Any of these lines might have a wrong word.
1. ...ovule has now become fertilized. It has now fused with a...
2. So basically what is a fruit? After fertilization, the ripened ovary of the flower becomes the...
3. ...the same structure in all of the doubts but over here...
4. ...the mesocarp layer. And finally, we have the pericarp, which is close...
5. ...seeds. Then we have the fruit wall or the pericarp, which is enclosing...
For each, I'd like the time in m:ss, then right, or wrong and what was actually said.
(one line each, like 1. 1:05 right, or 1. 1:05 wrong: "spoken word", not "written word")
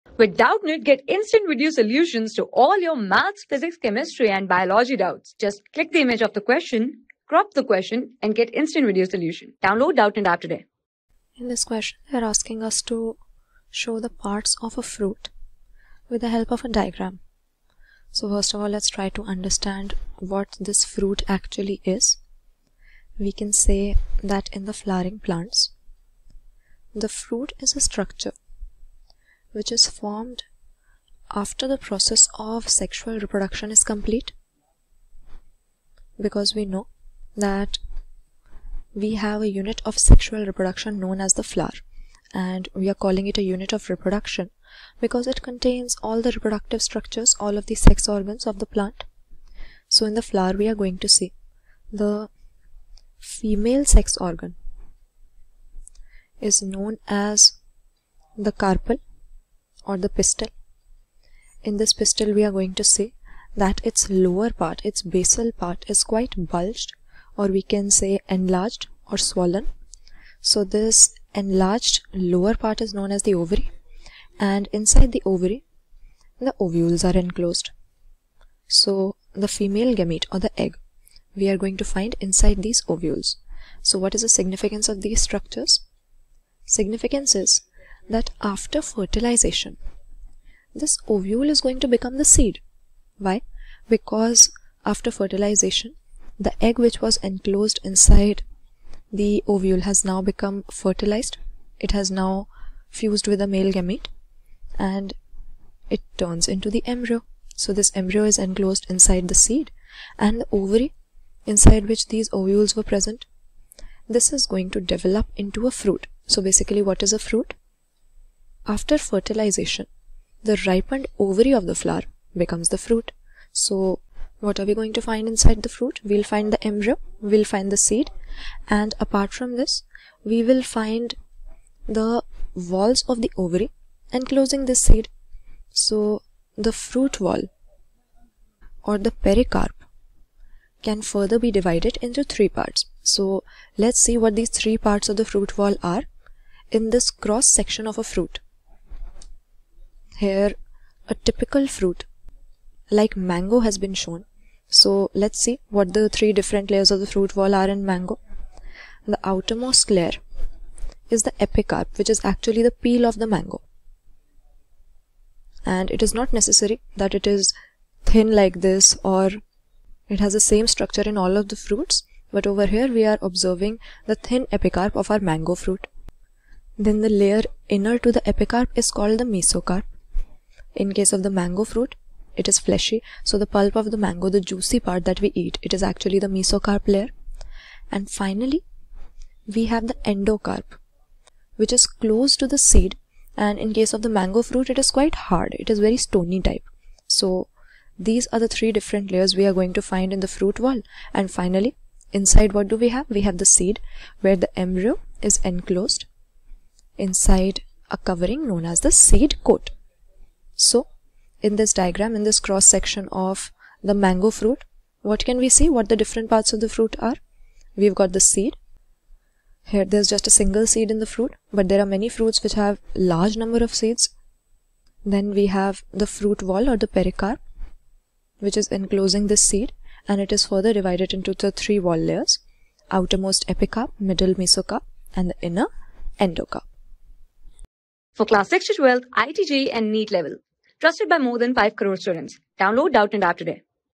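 1. 1:39 right
2. 1:56 right
3. 2:50 wrong: "fruits", not "doubts"
4. 3:06 wrong: "endocarp", not "pericarp"
5. 3:43 right.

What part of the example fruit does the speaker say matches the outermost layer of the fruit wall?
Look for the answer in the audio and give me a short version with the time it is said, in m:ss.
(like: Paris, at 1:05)
The peel, at 2:42.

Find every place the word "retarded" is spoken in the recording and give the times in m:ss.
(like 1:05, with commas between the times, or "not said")
not said.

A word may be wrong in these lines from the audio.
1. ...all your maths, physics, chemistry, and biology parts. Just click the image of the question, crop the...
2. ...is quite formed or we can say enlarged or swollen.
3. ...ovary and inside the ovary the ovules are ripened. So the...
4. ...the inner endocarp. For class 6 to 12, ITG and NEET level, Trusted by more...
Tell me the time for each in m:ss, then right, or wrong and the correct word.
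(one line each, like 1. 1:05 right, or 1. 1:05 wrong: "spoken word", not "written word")
1. 0:02 wrong: "doubts", not "parts"
2. 1:05 wrong: "bulged", not "formed"
3. 1:13 wrong: "enclosed", not "ripened"
4. 3:55 right.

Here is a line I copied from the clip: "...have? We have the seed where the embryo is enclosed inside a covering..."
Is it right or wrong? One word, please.
right.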